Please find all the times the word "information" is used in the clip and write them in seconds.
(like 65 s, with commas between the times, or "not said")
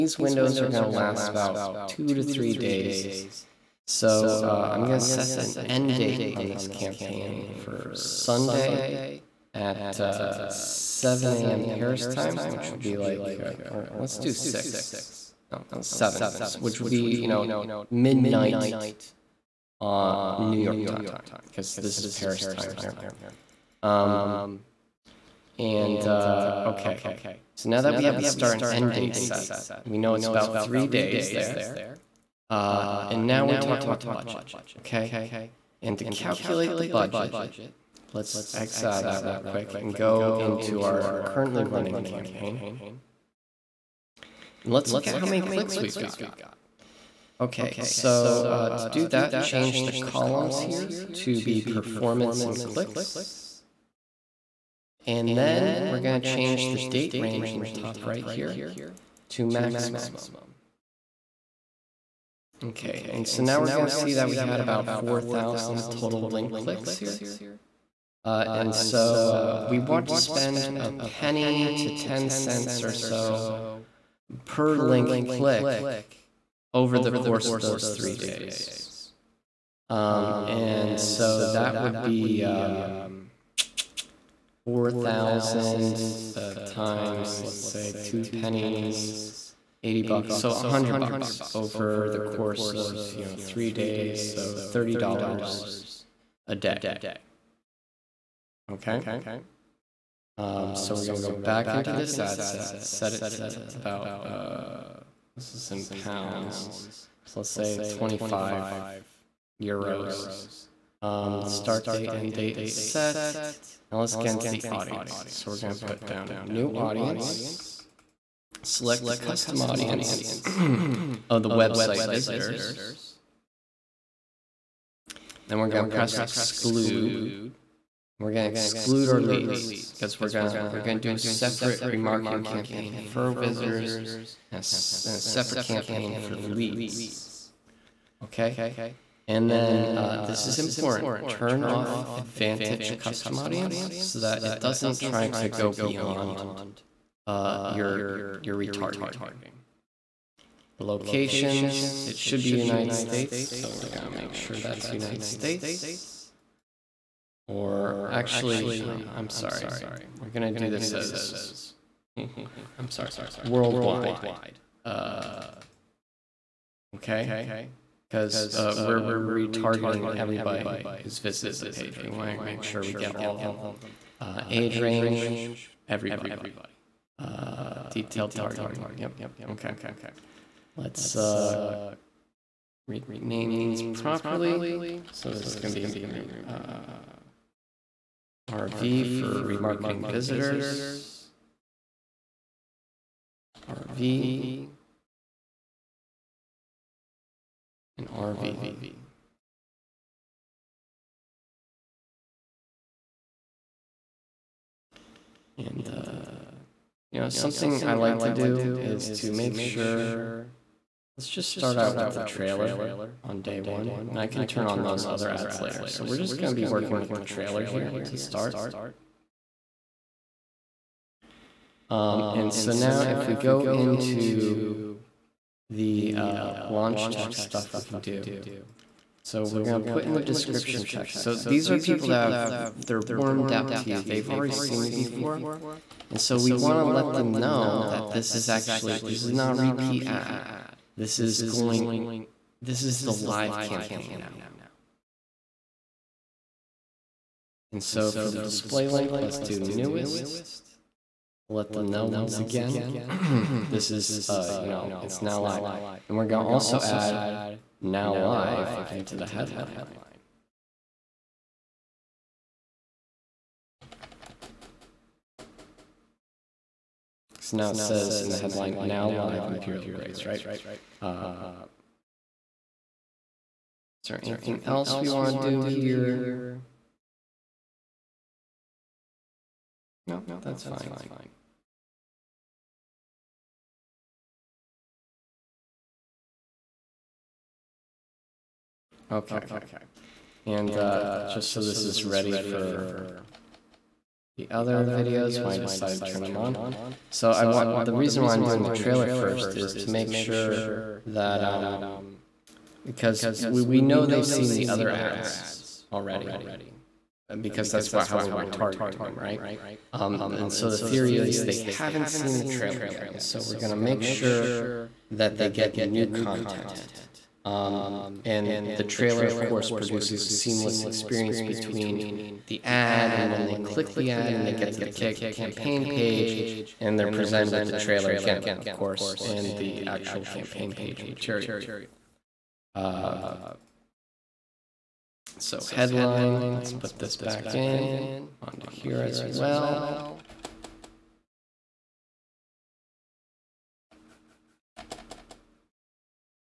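not said.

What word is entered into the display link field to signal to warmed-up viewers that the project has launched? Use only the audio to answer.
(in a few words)
Newest.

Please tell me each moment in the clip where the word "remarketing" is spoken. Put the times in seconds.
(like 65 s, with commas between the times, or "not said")
131 s, 189 s.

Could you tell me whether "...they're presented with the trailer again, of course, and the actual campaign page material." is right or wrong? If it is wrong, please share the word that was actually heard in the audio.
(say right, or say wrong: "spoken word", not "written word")
right.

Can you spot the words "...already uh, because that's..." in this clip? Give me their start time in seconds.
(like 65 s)
305 s.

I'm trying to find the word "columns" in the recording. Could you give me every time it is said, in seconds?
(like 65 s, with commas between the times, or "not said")
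49 s.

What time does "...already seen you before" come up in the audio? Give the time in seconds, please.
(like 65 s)
234 s.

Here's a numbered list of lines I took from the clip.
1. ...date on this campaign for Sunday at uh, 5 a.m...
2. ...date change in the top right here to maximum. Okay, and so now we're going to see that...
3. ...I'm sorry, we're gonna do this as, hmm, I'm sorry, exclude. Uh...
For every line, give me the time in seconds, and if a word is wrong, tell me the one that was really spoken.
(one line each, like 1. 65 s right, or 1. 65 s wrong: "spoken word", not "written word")
1. 5 s wrong: "7", not "5"
2. 56 s wrong: "range", not "change"
3. 159 s wrong: "worldwide", not "exclude".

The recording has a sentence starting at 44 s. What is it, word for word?
And let's look at how many clicks we've got.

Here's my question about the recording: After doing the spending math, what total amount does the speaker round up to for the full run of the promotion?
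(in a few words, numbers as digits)
$100.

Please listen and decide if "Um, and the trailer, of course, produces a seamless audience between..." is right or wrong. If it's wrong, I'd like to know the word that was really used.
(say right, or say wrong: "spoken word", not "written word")
wrong: "experience", not "audience".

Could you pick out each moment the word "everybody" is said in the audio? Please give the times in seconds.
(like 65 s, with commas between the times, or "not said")
170 s, 175 s.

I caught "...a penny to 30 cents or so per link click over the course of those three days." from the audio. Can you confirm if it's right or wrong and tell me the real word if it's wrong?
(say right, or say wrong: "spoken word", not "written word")
wrong: "10", not "30".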